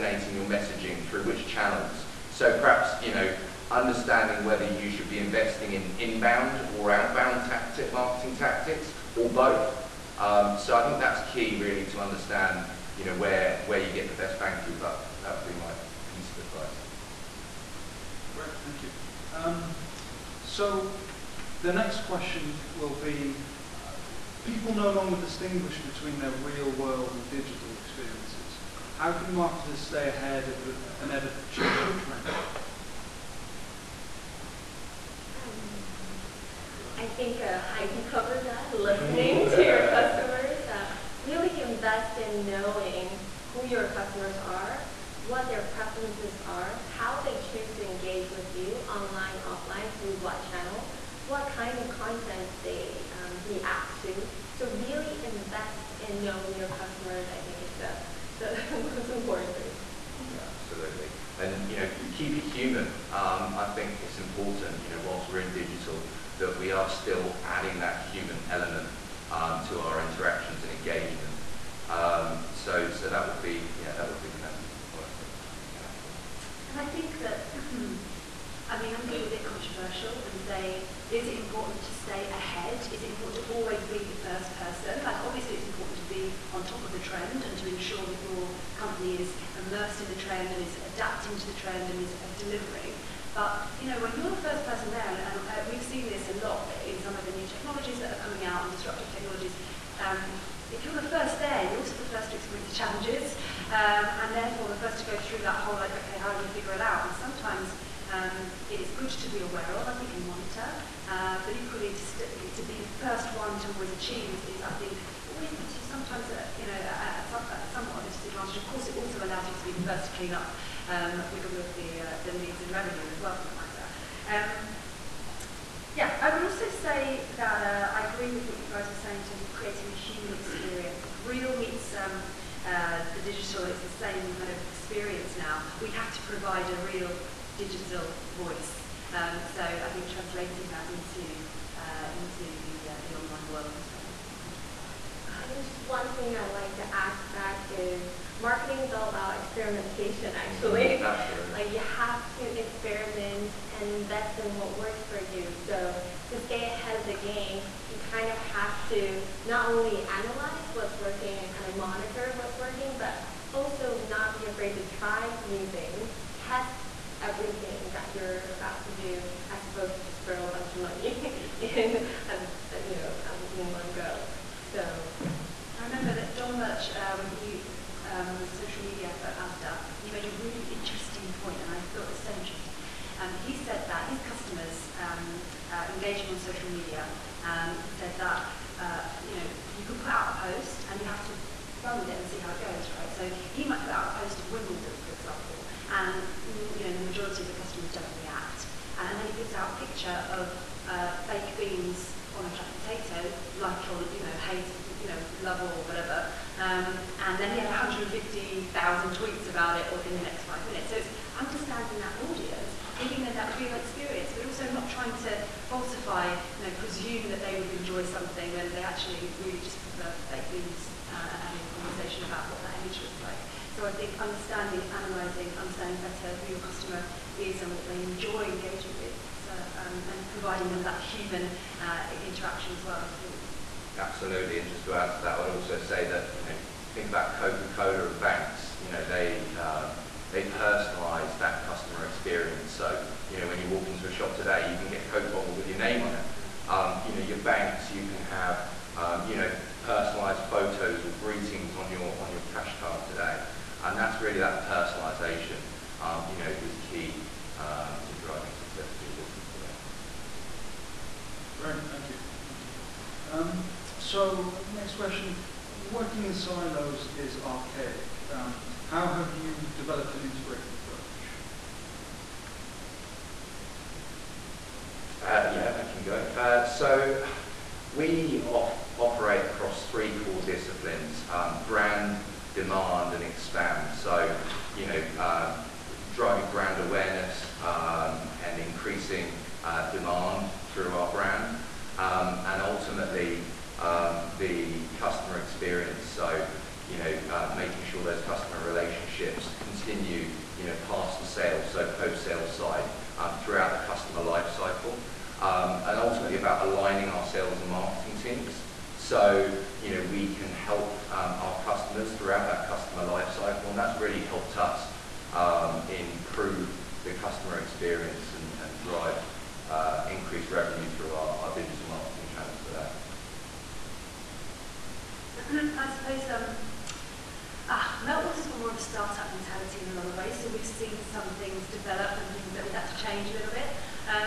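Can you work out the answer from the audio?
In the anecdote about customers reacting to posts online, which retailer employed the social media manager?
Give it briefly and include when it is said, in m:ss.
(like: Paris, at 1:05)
ASDA, at 2:59.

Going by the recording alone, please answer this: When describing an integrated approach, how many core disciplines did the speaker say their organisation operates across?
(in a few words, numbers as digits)
3.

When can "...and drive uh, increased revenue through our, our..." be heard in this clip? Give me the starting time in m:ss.
5:18.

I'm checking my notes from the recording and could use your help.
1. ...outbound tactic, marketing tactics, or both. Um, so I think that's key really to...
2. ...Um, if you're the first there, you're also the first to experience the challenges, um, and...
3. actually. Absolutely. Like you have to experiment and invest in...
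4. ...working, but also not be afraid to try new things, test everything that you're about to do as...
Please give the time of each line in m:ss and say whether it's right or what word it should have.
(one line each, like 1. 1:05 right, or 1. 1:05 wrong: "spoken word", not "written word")
1. 0:06 right
2. 1:40 right
3. 2:30 right
4. 2:42 right.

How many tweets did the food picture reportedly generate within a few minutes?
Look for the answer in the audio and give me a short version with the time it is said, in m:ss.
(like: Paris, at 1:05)
150,000, at 3:27.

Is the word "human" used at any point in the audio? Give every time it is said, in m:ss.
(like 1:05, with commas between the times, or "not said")
1:02, 1:08, 2:09, 3:51.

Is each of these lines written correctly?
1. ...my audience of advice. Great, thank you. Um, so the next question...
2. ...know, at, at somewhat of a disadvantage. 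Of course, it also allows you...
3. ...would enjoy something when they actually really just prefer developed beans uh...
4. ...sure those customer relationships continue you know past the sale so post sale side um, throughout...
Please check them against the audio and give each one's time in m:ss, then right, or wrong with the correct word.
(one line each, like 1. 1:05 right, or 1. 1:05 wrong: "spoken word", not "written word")
1. 0:15 wrong: "piece", not "audience"
2. 1:56 right
3. 3:37 wrong: "baked", not "developed"
4. 4:57 right.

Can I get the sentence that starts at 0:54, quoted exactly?
So really invest in knowing your customers.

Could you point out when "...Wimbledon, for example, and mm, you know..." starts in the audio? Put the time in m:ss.
3:14.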